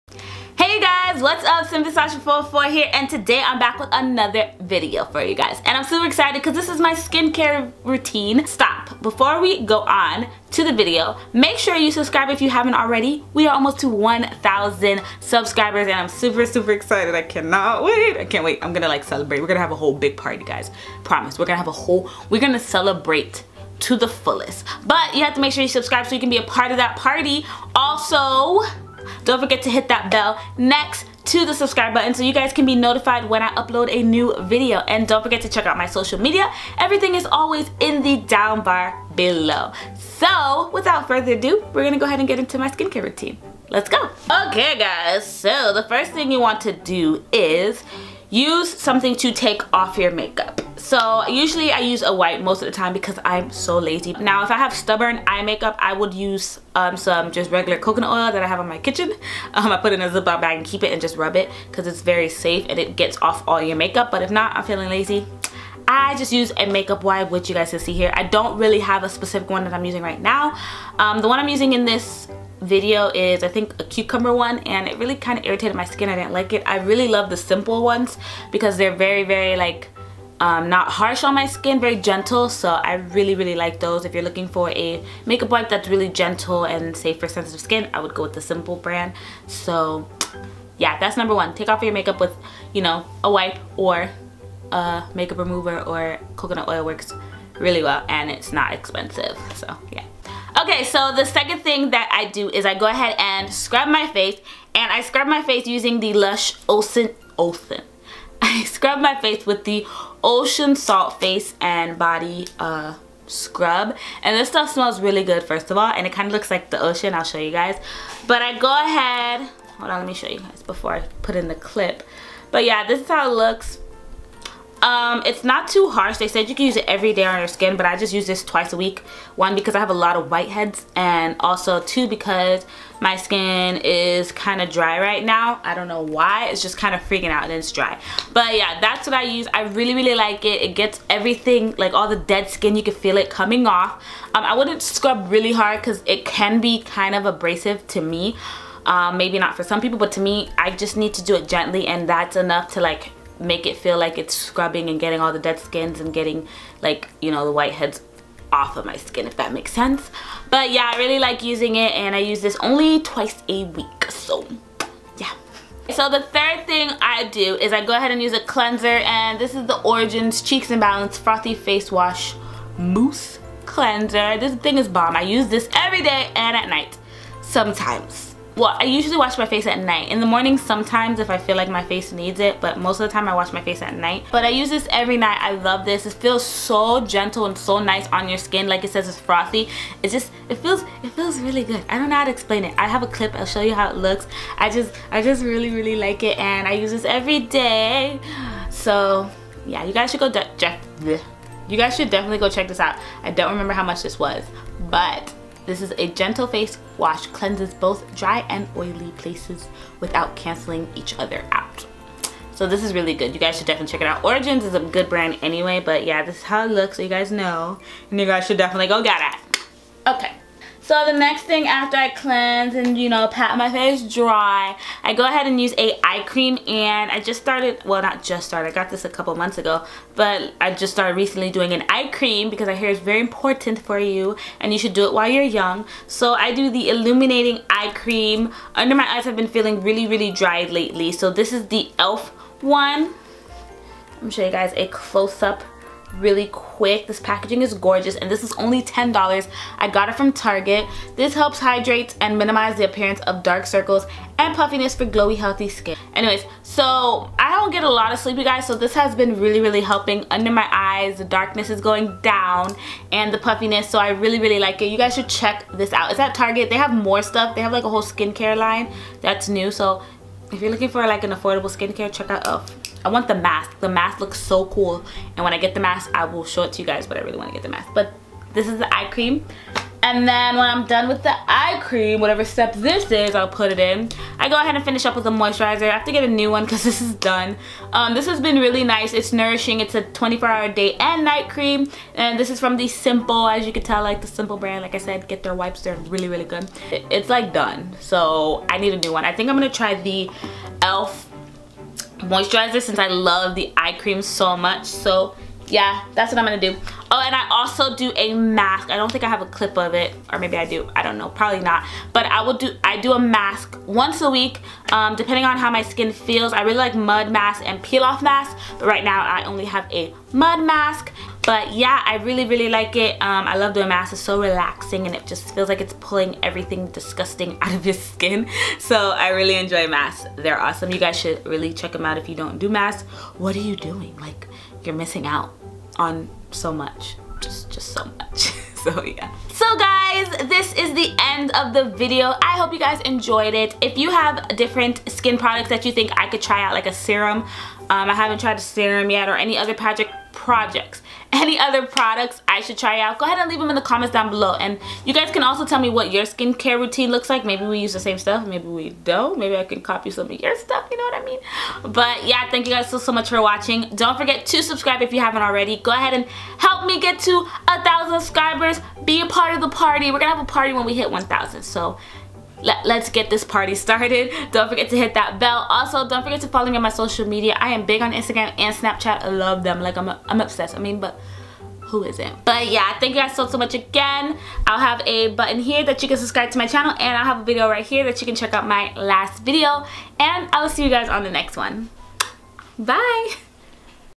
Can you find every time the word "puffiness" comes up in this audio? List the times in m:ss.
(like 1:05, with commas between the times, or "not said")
4:14, 4:23.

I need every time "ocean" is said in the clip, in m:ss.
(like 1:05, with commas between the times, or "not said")
1:50, 1:56.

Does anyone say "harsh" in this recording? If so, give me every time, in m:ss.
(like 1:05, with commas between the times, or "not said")
1:20, 2:05.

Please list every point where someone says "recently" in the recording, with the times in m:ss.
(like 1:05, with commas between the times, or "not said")
3:51.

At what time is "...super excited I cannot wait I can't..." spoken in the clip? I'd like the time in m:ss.
0:16.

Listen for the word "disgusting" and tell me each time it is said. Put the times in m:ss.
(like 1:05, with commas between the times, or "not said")
5:26.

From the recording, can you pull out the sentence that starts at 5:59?
Maybe I can copy some of your stuff, you know what I mean?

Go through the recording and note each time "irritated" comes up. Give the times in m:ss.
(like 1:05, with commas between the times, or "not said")
1:15.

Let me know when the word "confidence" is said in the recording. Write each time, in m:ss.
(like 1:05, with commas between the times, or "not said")
not said.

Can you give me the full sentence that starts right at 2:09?
One, because I have a lot of whiteheads, and also two, because my skin is kind of dry right now.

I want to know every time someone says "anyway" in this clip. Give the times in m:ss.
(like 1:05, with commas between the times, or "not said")
3:35, 4:16.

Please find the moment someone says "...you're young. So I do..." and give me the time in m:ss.
3:55.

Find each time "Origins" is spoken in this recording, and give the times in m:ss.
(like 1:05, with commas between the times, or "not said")
2:49, 3:34.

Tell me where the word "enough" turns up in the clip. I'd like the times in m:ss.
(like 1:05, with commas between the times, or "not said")
2:32.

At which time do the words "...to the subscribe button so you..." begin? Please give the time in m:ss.
0:31.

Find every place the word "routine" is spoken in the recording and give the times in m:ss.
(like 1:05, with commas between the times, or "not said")
0:07, 0:43, 5:56.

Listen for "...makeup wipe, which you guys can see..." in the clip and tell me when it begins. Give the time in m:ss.
1:06.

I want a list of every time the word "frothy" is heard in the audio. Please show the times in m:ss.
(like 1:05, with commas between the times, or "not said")
2:51, 3:09.